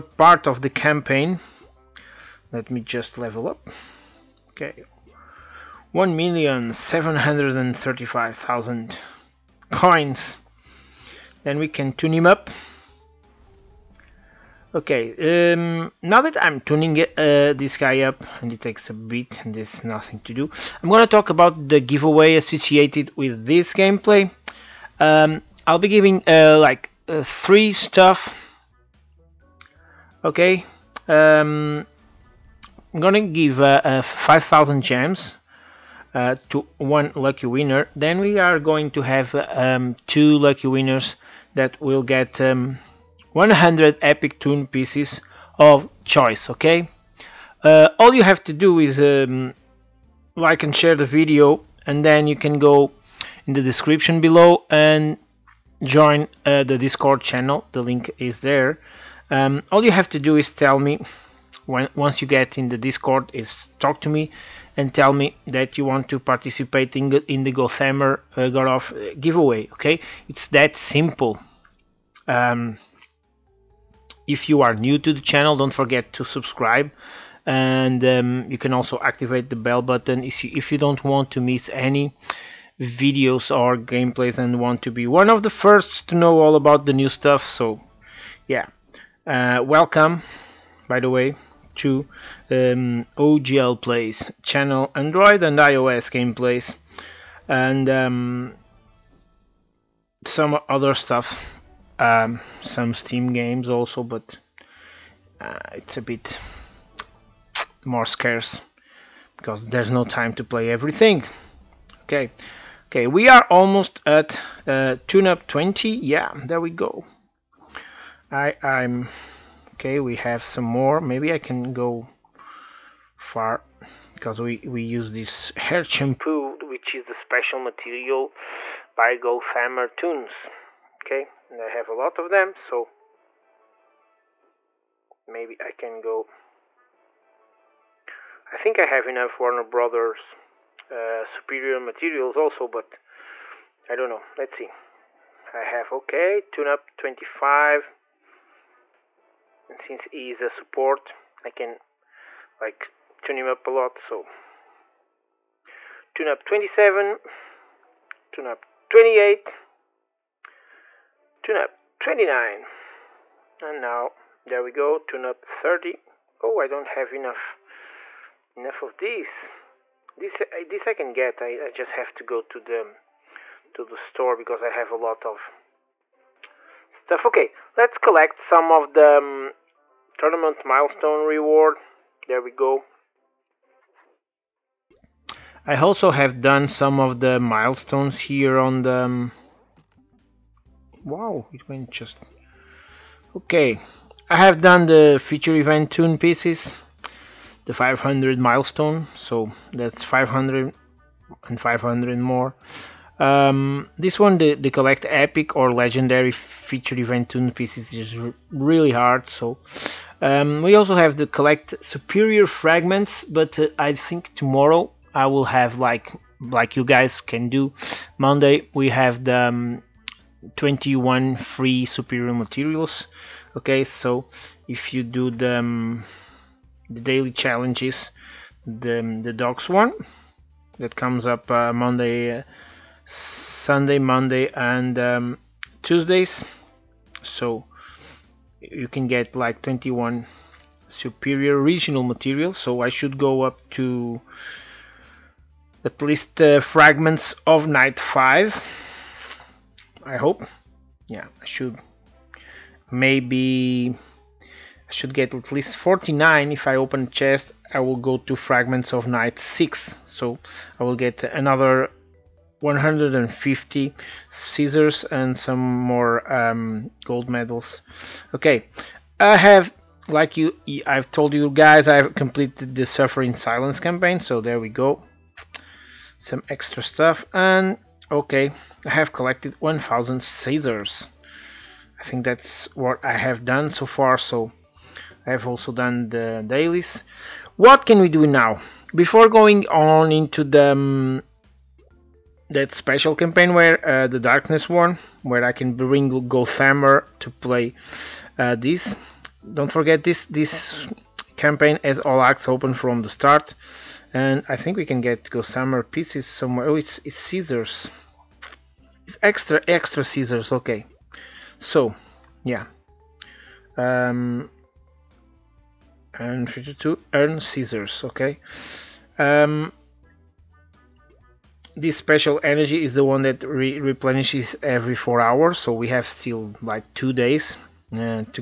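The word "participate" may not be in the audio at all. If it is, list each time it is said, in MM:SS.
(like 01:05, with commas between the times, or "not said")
01:06.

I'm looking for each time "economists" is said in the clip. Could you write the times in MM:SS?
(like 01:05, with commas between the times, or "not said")
not said.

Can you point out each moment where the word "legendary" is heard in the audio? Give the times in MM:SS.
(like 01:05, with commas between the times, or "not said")
03:25.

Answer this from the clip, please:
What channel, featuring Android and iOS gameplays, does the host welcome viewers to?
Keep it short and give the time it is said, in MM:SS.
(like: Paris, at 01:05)
OGL Plays, at 01:33.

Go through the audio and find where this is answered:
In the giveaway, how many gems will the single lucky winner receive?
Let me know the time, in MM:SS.
00:34.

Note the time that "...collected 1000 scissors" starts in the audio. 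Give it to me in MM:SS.
04:39.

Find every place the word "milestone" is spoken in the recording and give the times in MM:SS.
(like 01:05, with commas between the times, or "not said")
03:00, 03:07, 03:18.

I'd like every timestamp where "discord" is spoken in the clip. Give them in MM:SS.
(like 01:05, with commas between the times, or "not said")
00:56, 01:02.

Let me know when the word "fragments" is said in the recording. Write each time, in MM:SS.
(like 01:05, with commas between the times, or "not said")
03:32, 04:06, 04:18.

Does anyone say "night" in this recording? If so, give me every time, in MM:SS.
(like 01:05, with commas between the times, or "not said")
04:07, 04:19.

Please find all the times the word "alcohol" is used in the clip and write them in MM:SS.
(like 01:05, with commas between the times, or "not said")
not said.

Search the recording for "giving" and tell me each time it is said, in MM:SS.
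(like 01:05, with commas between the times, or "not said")
00:25.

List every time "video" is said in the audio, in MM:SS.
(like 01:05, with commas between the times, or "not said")
00:51, 01:22.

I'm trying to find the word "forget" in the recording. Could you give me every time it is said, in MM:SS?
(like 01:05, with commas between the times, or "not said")
01:15, 04:59.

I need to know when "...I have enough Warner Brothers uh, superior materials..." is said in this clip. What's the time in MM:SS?
02:18.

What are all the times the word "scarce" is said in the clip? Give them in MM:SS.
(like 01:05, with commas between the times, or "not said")
01:48.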